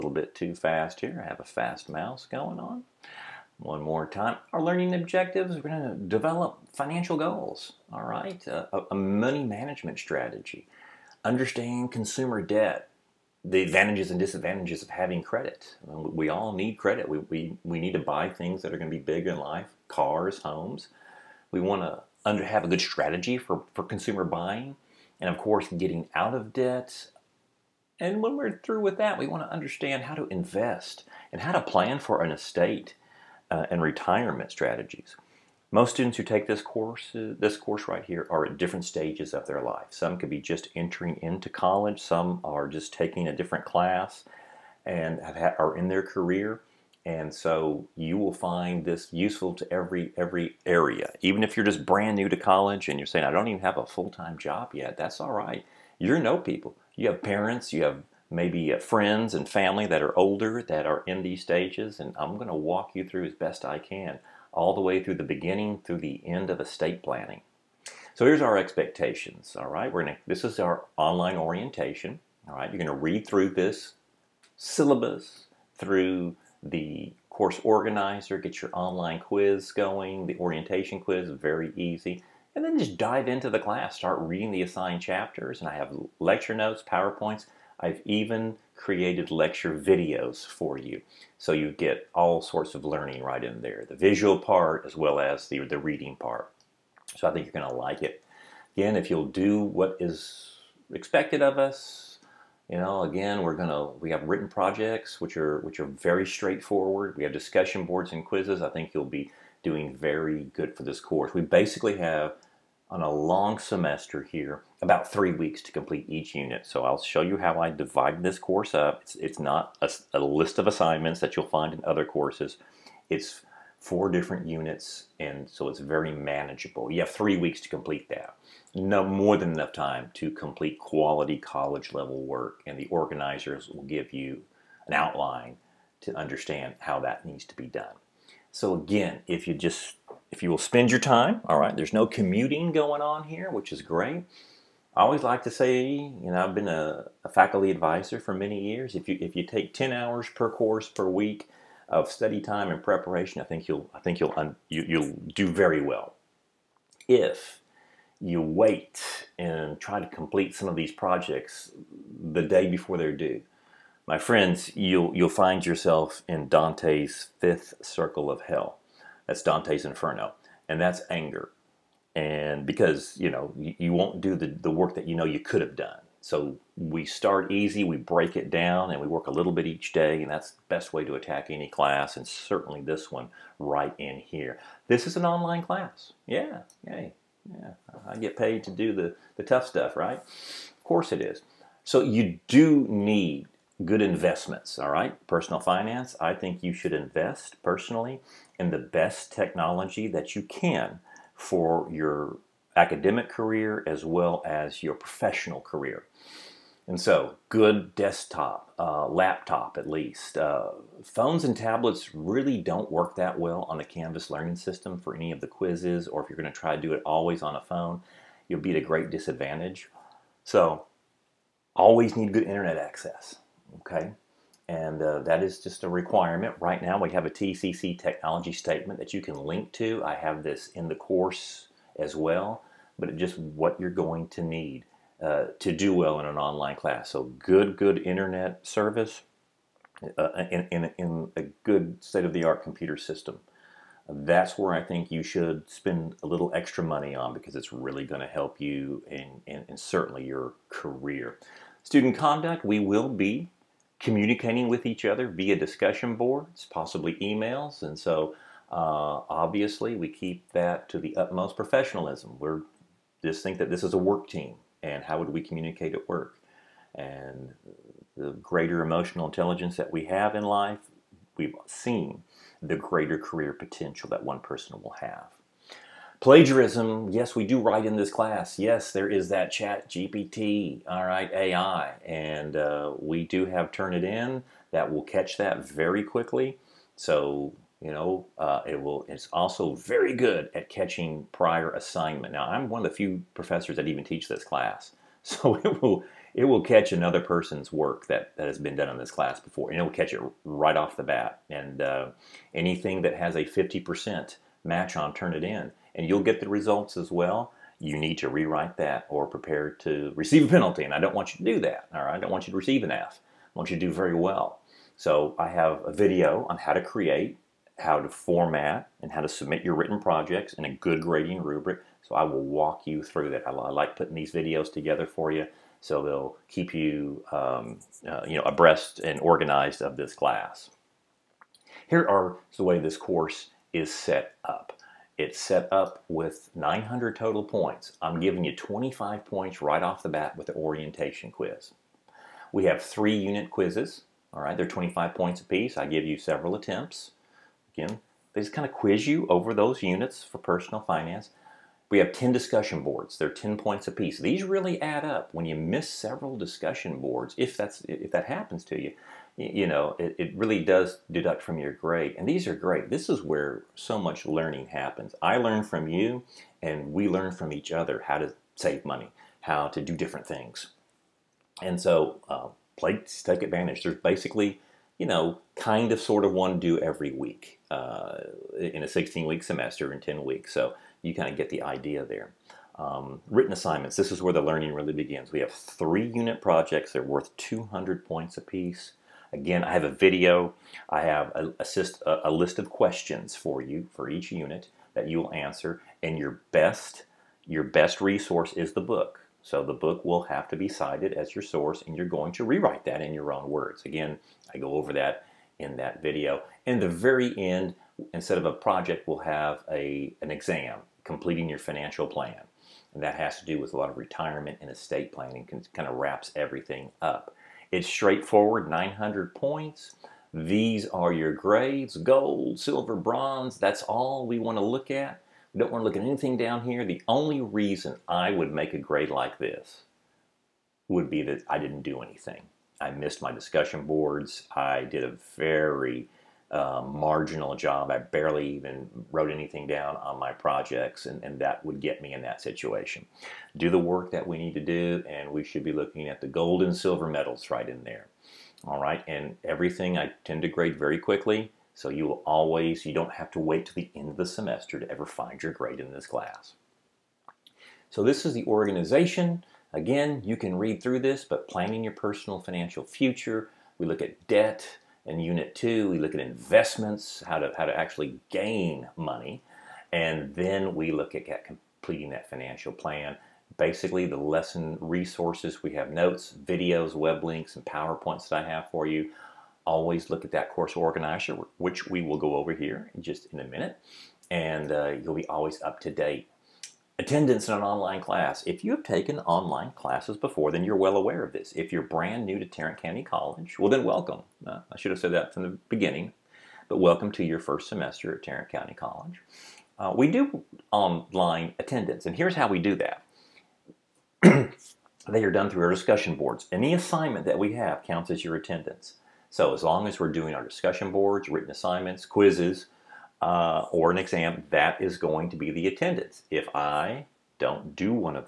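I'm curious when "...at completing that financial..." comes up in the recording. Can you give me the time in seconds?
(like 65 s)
471 s.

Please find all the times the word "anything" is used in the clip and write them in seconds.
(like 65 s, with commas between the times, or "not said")
302 s, 426 s, 432 s, 439 s.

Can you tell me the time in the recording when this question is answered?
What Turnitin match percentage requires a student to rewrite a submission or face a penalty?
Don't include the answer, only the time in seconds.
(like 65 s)
303 s.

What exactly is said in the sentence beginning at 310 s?
And I don't want you to do that.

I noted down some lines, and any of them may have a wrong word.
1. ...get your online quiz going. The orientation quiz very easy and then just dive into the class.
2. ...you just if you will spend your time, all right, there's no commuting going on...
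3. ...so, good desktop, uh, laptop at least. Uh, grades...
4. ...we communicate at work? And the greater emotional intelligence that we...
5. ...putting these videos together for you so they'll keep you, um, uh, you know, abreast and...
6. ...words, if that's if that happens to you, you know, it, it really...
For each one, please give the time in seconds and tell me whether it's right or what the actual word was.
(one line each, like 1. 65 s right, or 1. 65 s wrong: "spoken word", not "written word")
1. 78 s right
2. 139 s right
3. 207 s wrong: "phones", not "grades"
4. 265 s right
5. 323 s right
6. 356 s wrong: "boards", not "words".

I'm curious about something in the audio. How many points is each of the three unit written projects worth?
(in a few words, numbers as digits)
200.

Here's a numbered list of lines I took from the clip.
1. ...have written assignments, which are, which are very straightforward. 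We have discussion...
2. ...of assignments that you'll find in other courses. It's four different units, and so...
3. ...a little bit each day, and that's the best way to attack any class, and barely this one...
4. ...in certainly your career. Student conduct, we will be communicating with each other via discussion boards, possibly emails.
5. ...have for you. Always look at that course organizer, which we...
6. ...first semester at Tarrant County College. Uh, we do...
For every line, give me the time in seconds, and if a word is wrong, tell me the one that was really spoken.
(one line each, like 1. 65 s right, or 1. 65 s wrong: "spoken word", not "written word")
1. 104 s wrong: "projects", not "assignments"
2. 120 s right
3. 179 s wrong: "certainly", not "barely"
4. 249 s right
5. 478 s right
6. 497 s right.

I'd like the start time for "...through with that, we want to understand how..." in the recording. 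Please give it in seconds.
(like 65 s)
28 s.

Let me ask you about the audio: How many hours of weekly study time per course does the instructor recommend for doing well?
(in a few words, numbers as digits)
10.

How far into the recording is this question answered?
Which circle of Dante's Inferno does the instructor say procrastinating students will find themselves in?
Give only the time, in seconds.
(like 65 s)
167 s.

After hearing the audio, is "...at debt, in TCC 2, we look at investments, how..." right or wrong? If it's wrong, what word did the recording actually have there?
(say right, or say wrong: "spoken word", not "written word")
wrong: "Unit", not "TCC".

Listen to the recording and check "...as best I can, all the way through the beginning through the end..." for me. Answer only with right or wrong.
right.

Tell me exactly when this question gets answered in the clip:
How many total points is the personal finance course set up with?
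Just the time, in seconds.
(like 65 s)
336 s.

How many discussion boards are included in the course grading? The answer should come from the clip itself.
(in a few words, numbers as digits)
10.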